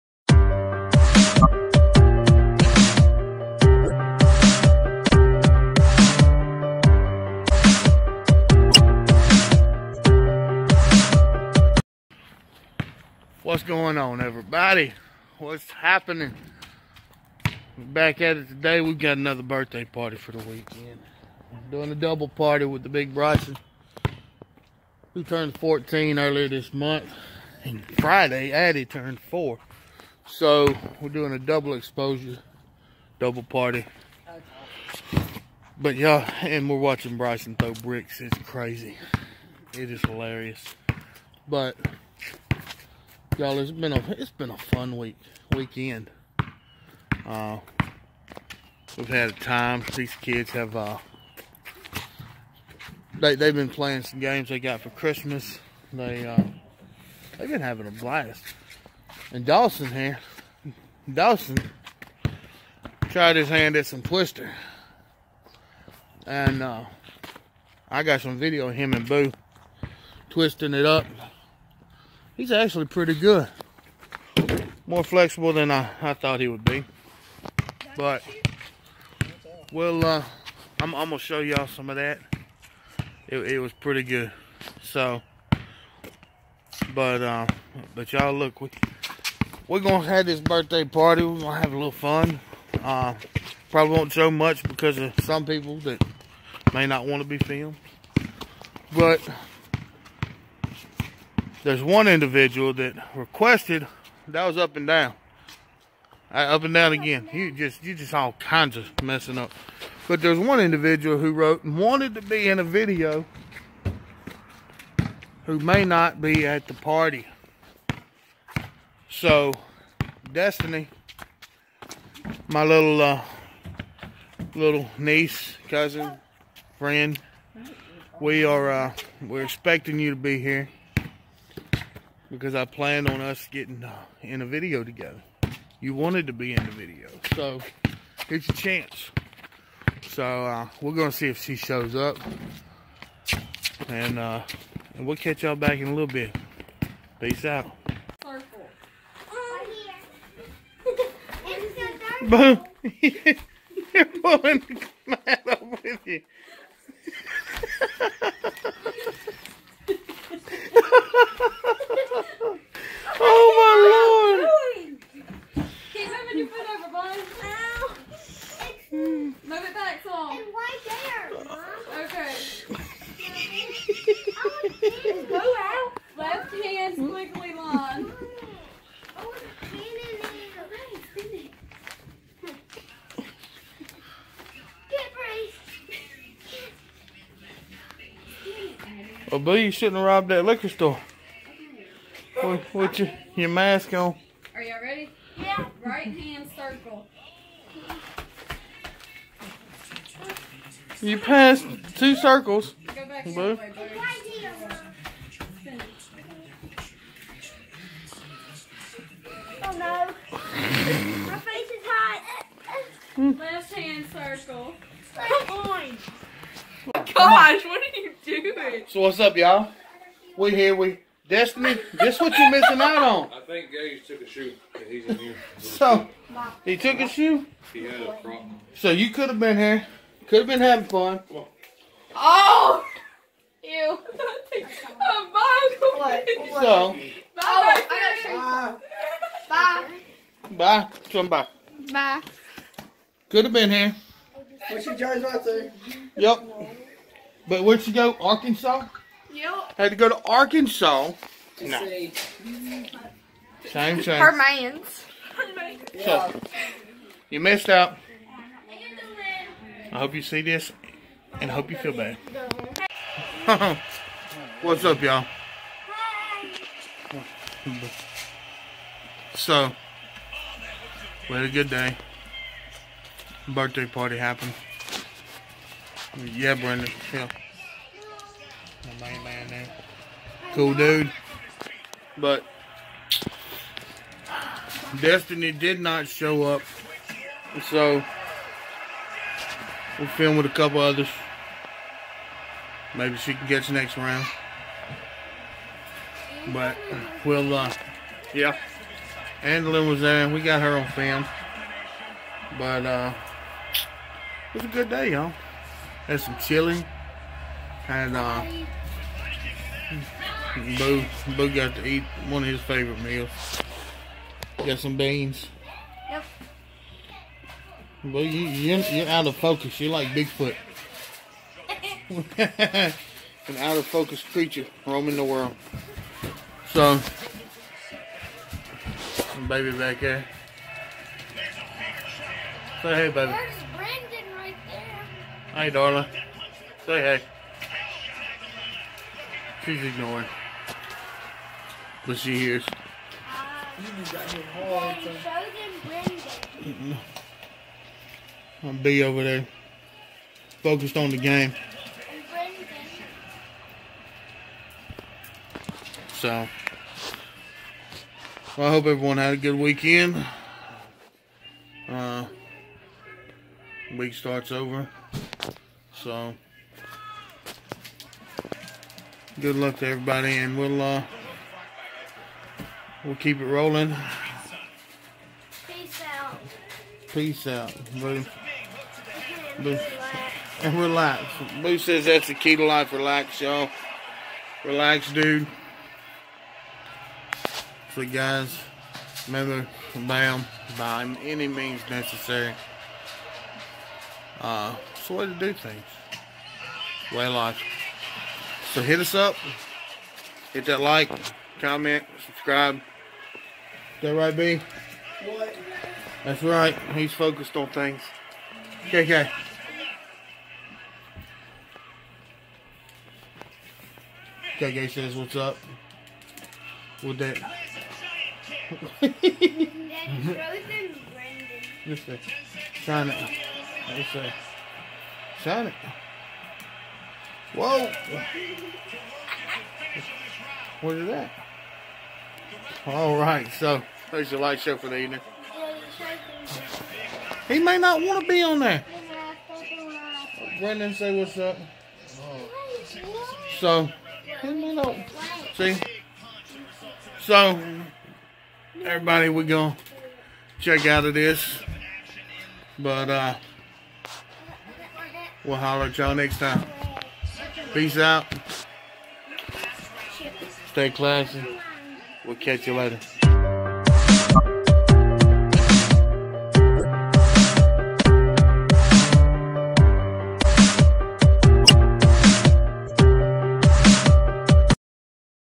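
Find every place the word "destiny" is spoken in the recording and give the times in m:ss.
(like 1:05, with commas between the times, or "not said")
2:00, 3:41, 4:44.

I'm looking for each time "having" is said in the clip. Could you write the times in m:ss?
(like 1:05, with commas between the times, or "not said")
0:57, 3:50.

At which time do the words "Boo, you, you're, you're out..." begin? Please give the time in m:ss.
5:18.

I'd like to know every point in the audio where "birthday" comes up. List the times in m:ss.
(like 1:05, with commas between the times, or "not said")
0:19, 1:30, 4:33.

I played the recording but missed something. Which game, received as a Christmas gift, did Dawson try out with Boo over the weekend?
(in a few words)
Twister.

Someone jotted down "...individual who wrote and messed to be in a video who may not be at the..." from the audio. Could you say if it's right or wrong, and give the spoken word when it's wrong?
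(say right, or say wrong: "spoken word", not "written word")
wrong: "wanted", not "messed".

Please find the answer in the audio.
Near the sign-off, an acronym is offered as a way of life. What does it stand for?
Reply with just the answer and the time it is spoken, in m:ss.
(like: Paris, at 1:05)
By any means necessary, at 6:30.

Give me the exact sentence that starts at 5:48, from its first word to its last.
I'm be over there, focused on the game.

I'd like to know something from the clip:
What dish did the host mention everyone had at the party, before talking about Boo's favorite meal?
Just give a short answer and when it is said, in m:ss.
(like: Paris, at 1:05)
Chili, at 5:06.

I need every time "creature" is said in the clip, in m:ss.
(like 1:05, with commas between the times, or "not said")
5:24.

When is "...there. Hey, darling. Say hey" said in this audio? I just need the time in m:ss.
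5:34.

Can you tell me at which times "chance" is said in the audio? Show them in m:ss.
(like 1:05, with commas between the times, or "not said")
2:18.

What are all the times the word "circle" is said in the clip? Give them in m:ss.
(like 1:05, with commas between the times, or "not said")
3:16, 3:22, 3:34.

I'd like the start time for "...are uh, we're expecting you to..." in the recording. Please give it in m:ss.
2:08.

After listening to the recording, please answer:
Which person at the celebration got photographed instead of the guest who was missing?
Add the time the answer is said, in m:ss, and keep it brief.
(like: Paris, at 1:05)
Angela, at 4:59.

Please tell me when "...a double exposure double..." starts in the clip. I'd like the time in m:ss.
0:31.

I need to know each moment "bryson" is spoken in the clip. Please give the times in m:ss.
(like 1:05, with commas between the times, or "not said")
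0:23, 0:37.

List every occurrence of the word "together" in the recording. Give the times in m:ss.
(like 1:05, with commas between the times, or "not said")
2:14.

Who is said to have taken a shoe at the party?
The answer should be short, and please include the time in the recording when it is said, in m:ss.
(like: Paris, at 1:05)
Gage, at 3:43.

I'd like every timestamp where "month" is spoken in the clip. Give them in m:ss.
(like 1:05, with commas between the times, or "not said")
0:26.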